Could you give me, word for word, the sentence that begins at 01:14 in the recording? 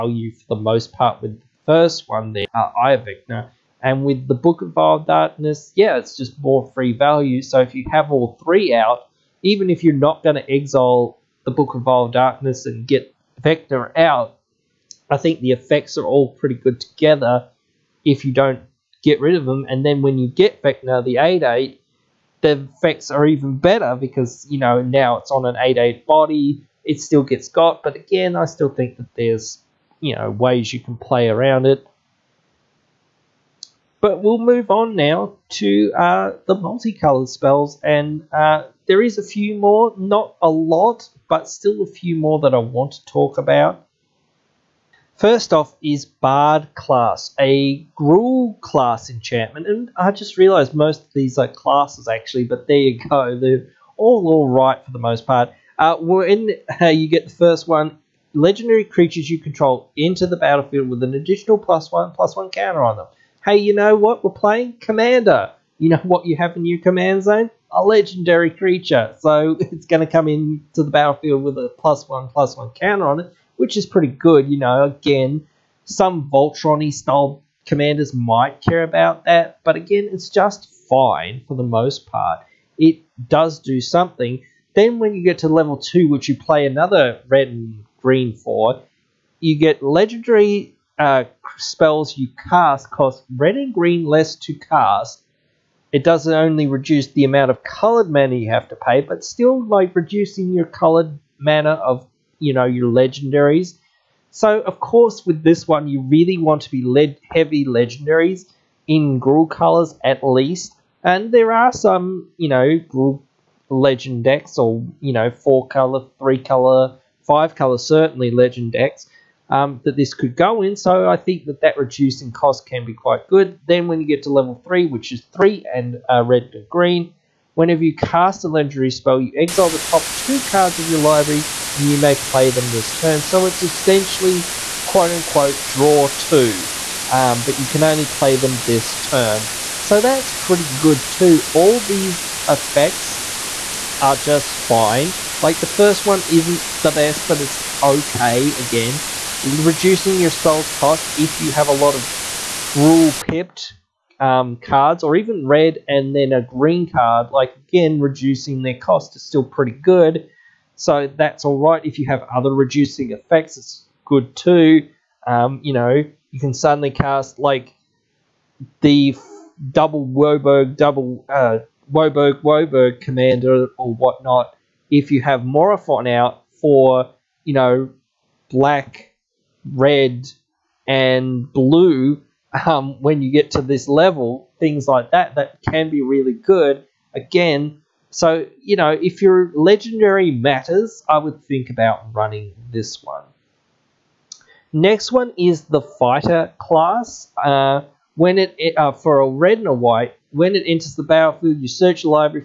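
You know, again, some Voltron style commanders might care about that, but again, it's just fine for the most part.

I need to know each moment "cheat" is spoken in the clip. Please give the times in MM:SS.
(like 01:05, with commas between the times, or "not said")
not said.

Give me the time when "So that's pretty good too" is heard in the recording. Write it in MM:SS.
02:19.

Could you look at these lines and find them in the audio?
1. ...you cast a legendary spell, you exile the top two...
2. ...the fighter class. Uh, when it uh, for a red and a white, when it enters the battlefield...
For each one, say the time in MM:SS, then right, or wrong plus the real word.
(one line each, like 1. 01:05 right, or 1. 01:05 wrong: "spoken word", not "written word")
1. 02:07 right
2. 03:15 right.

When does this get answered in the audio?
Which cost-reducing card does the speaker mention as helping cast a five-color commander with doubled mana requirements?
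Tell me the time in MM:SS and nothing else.
02:55.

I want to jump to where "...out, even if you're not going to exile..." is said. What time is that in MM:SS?
00:08.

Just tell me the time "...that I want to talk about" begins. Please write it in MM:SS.
00:42.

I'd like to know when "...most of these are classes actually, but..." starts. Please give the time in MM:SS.
00:50.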